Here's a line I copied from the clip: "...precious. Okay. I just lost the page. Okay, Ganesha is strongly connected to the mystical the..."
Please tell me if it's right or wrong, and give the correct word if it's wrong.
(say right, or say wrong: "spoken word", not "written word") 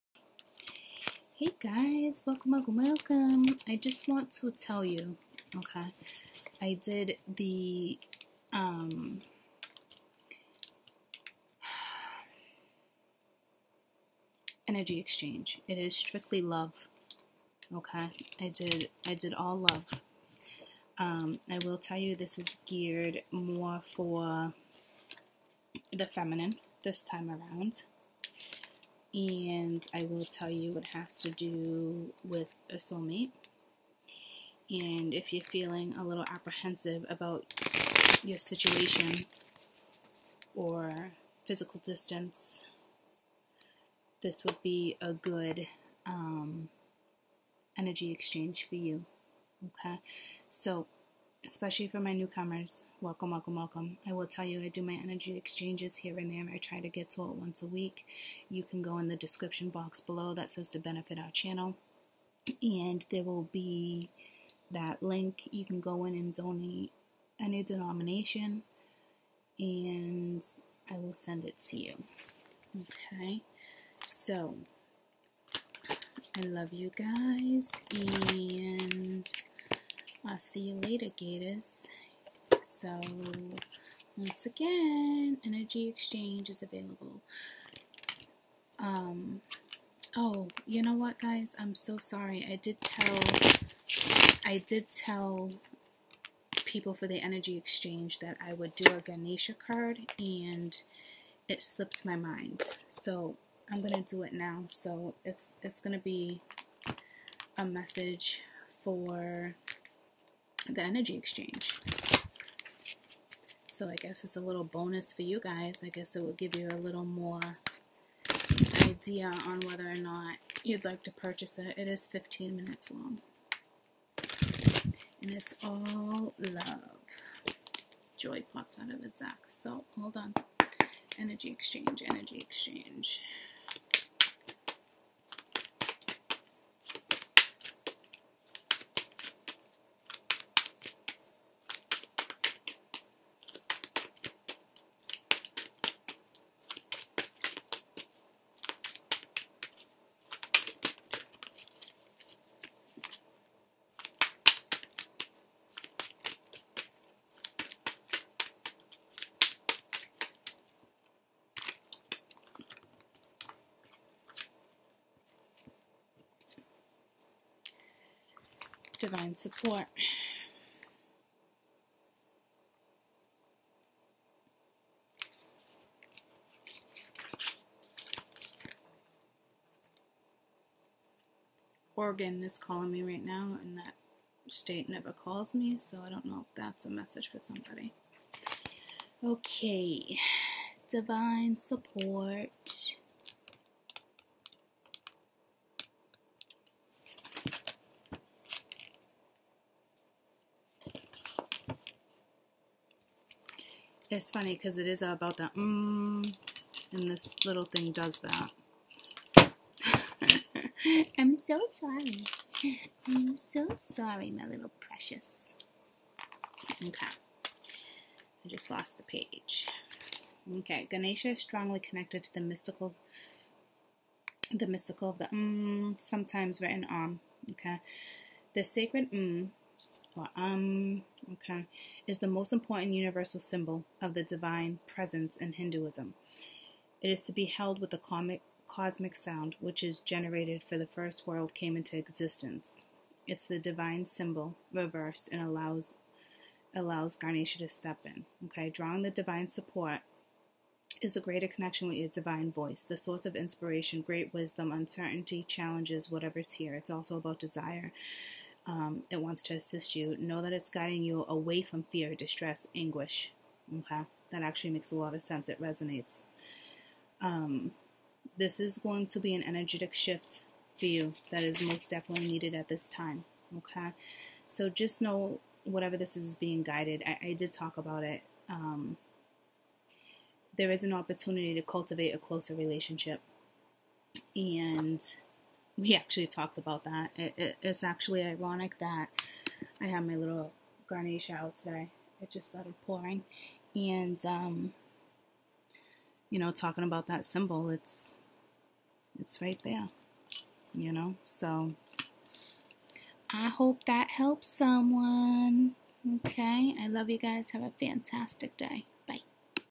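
right.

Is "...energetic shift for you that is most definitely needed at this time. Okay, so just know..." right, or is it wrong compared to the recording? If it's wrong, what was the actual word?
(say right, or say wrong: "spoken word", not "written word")
right.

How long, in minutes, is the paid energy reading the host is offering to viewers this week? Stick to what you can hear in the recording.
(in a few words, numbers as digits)
15 minutes.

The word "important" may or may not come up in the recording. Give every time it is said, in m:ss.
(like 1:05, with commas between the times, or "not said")
3:52.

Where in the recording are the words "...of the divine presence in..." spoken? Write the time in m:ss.
3:54.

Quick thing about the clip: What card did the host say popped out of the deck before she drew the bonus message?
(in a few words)
Joy.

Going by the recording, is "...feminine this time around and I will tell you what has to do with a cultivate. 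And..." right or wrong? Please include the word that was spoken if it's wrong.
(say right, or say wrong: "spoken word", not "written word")
wrong: "soulmate", not "cultivate".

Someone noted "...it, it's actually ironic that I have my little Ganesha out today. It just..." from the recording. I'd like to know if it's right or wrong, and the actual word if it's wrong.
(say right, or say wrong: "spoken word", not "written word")
right.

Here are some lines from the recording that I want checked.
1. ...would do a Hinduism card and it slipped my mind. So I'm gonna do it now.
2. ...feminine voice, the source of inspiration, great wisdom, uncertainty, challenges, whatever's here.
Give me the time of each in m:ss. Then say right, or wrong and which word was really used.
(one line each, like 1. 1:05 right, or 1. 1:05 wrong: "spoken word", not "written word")
1. 1:38 wrong: "Ganesha", not "Hinduism"
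2. 4:12 wrong: "divine", not "feminine".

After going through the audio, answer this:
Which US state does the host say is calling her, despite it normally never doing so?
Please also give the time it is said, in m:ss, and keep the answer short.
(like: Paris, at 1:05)
Oregon, at 3:01.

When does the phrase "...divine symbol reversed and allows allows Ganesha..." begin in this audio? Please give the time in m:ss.
4:03.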